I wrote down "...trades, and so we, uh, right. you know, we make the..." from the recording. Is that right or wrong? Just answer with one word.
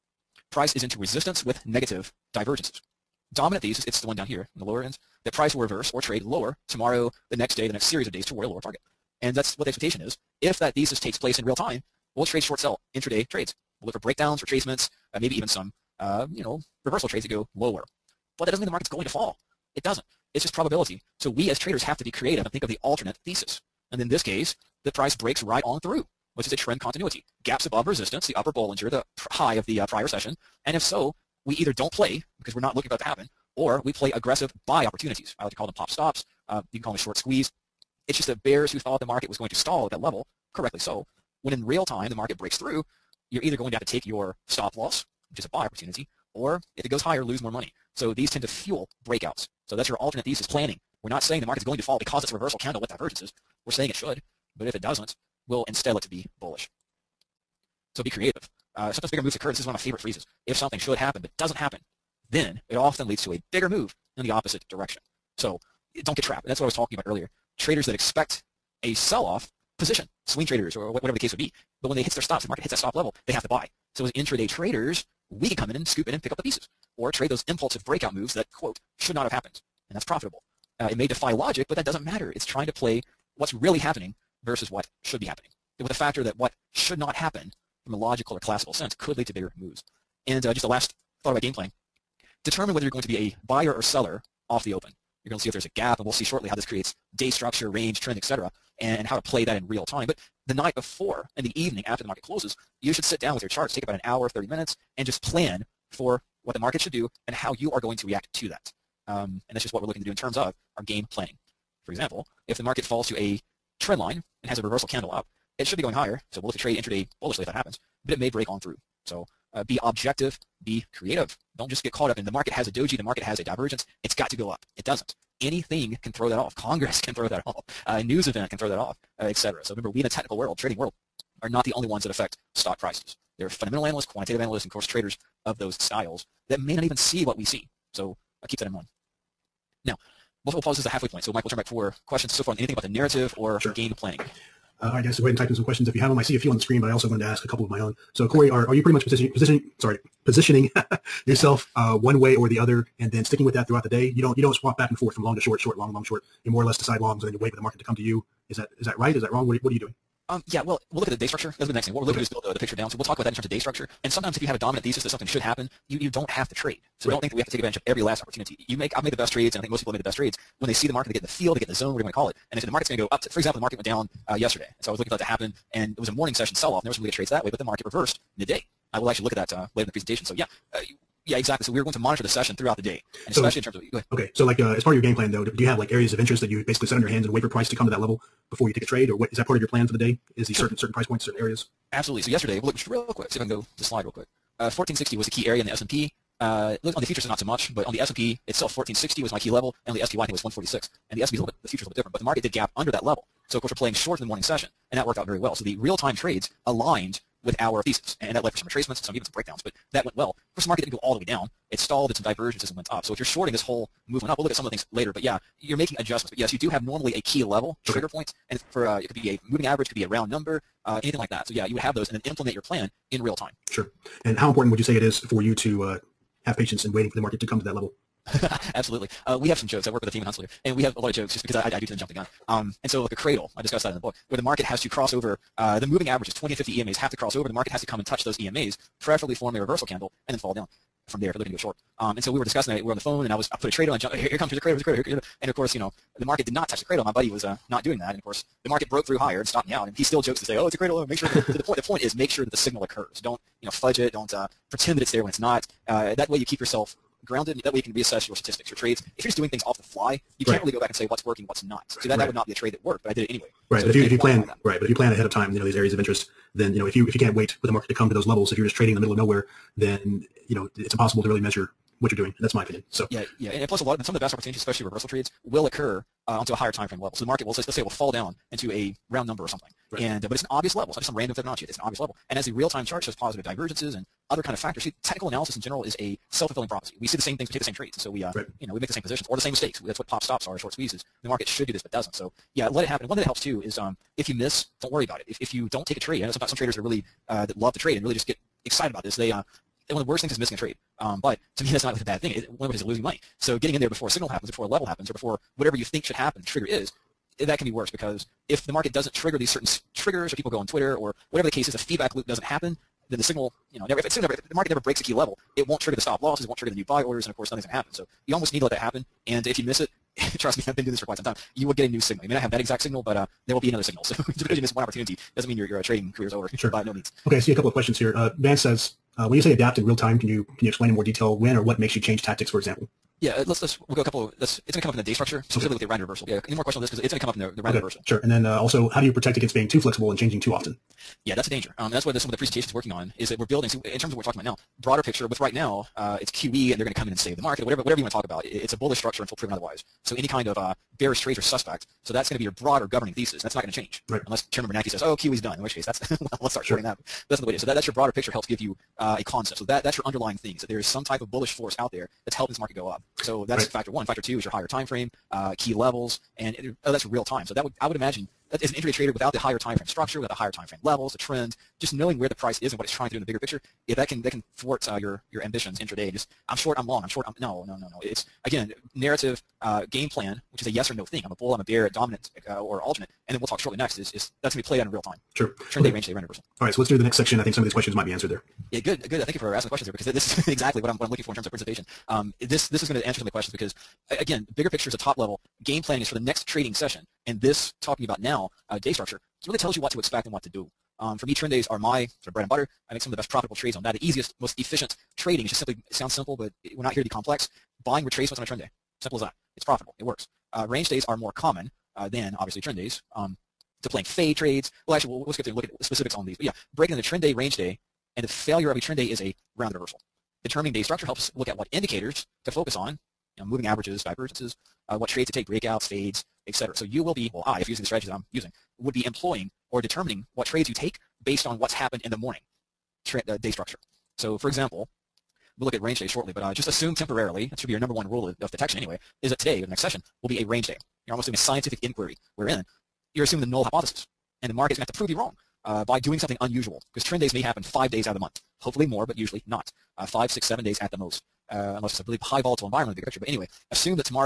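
right.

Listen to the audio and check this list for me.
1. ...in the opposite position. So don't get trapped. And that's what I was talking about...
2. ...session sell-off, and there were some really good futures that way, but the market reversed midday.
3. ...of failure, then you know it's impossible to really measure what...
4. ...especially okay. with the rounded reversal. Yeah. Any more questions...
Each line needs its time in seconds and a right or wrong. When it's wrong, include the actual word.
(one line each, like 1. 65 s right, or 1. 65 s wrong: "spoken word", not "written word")
1. 64 s wrong: "direction", not "position"
2. 176 s wrong: "trades", not "futures"
3. 269 s wrong: "nowhere", not "failure"
4. 335 s wrong: "specifically", not "especially".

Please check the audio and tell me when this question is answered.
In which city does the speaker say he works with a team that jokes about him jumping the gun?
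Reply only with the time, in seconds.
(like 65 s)
230 s.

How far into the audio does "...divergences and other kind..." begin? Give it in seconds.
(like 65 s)
283 s.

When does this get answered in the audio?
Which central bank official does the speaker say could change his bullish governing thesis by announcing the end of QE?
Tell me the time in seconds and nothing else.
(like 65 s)
354 s.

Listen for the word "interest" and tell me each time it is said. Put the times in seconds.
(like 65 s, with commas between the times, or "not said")
186 s, 265 s.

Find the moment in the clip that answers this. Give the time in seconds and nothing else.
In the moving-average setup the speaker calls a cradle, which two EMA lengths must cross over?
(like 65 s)
236 s.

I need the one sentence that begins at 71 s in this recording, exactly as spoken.
But when they hit their stops, the market hits that stop level, they have to buy.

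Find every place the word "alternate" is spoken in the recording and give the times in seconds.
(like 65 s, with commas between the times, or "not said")
22 s, 49 s, 382 s.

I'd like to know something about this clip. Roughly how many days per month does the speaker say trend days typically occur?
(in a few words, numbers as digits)
5.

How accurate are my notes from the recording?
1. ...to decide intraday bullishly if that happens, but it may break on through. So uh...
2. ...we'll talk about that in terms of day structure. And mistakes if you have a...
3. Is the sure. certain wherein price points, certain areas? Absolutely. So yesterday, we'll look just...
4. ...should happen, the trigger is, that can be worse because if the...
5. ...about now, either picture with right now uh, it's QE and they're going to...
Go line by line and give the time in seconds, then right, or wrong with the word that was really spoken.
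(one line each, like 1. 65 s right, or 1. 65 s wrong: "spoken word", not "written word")
1. 116 s wrong: "trade", not "decide"
2. 162 s wrong: "sometimes", not "mistakes"
3. 190 s wrong: "certain", not "wherein"
4. 306 s right
5. 344 s wrong: "broader", not "either".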